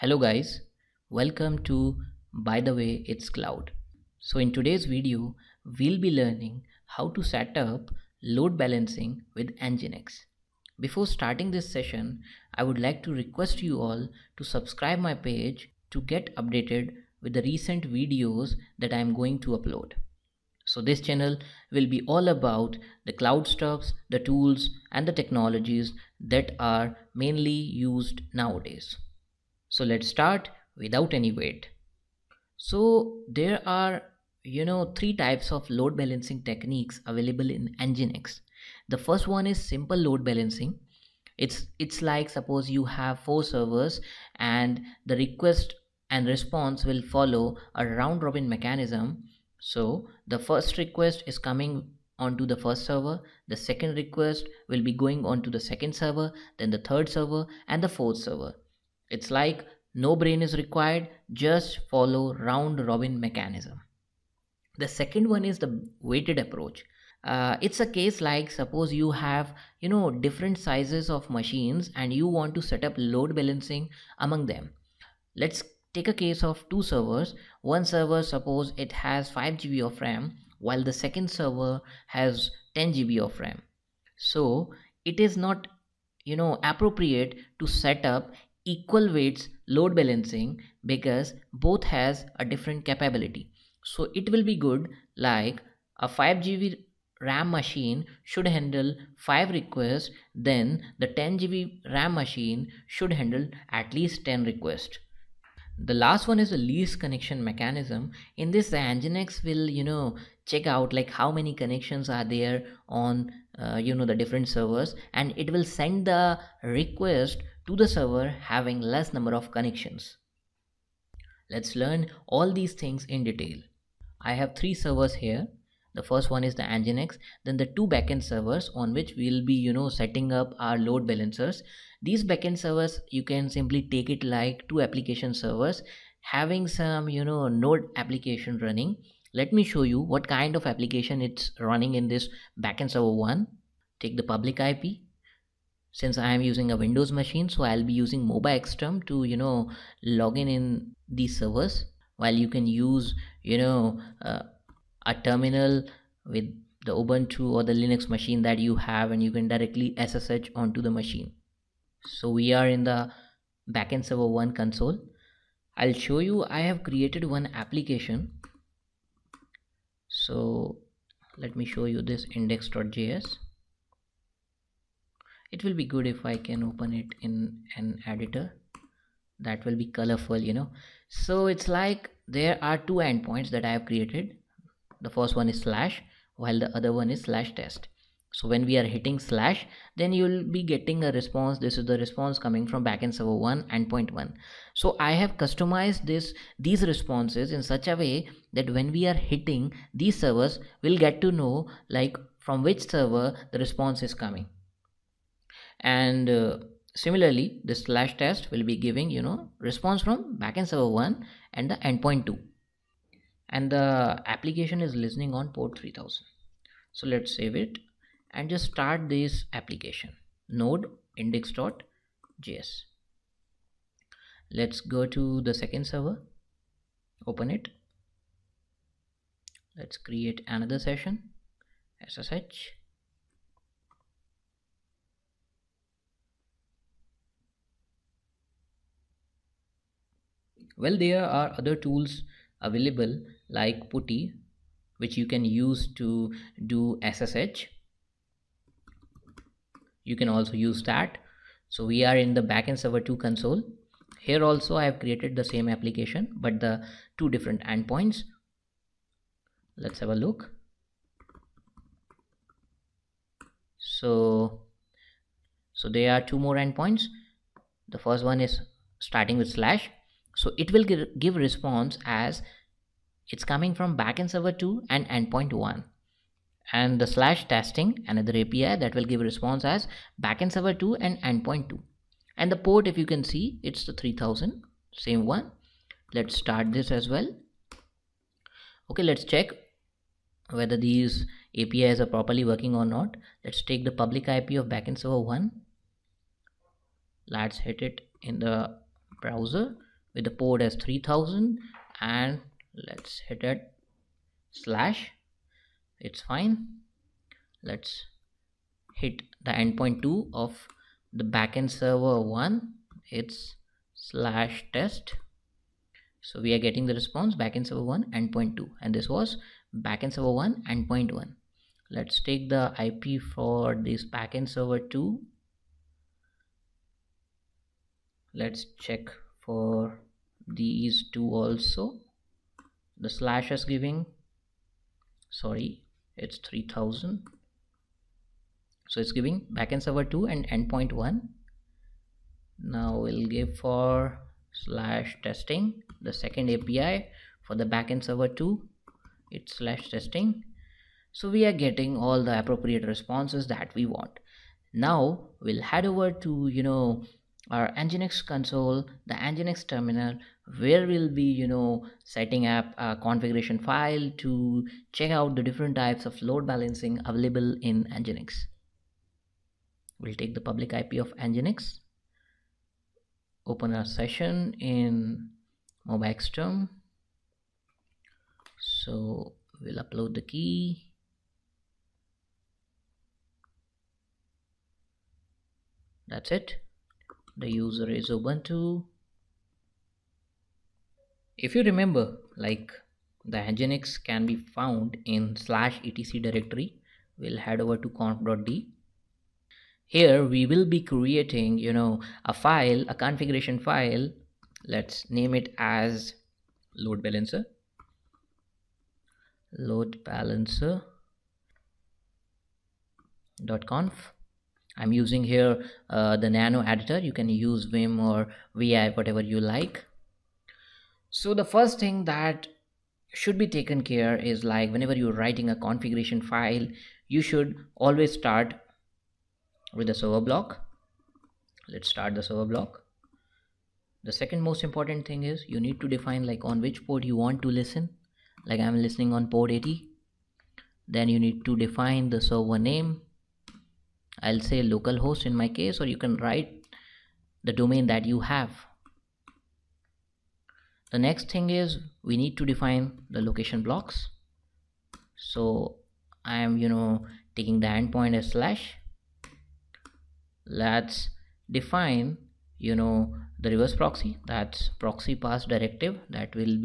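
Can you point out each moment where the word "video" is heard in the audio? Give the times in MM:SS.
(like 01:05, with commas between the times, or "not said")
00:04, 00:17.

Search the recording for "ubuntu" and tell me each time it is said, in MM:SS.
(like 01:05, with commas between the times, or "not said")
02:36, 06:28.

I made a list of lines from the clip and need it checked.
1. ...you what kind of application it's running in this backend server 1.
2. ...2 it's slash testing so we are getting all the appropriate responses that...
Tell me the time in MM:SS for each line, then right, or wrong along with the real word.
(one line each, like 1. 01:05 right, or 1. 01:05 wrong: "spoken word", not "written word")
1. 02:19 right
2. 05:48 right.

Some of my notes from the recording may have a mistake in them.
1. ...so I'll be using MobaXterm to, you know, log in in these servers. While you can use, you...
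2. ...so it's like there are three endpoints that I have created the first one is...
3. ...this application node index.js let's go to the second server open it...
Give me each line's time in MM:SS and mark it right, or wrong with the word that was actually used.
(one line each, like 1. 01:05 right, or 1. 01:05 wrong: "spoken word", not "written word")
1. 02:27 right
2. 03:01 wrong: "two", not "three"
3. 03:39 right.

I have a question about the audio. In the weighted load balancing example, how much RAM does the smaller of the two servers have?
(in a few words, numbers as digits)
5 GB.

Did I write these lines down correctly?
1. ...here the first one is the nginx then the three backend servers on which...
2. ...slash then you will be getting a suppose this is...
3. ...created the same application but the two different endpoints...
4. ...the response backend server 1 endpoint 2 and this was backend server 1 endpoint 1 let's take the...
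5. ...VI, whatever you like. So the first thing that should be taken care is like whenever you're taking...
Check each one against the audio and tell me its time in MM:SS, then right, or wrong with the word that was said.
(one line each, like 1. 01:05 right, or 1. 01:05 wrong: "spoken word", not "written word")
1. 02:05 wrong: "two", not "three"
2. 03:09 wrong: "response", not "suppose"
3. 04:14 right
4. 05:16 right
5. 06:58 wrong: "writing", not "taking".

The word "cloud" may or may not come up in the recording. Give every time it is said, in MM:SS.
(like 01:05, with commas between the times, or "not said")
00:03, 00:23.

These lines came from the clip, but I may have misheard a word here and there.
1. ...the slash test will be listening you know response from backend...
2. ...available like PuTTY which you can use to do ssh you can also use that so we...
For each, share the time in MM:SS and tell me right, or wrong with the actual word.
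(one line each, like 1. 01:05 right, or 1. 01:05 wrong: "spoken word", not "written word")
1. 03:27 wrong: "giving", not "listening"
2. 04:02 right.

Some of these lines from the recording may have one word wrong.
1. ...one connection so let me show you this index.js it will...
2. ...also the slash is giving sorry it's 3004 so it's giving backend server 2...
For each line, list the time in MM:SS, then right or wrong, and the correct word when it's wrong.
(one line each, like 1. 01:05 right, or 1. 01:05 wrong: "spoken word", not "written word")
1. 02:47 wrong: "application", not "connection"
2. 05:31 wrong: "3000", not "3004".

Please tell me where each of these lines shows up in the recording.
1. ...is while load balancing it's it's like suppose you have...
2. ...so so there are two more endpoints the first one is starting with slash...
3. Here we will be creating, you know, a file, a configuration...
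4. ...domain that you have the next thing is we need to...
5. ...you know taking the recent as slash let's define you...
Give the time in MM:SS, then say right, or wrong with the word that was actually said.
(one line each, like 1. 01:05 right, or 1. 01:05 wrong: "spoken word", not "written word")
1. 00:39 wrong: "simple", not "while"
2. 04:23 right
3. 06:39 right
4. 07:27 right
5. 07:36 wrong: "endpoint", not "recent".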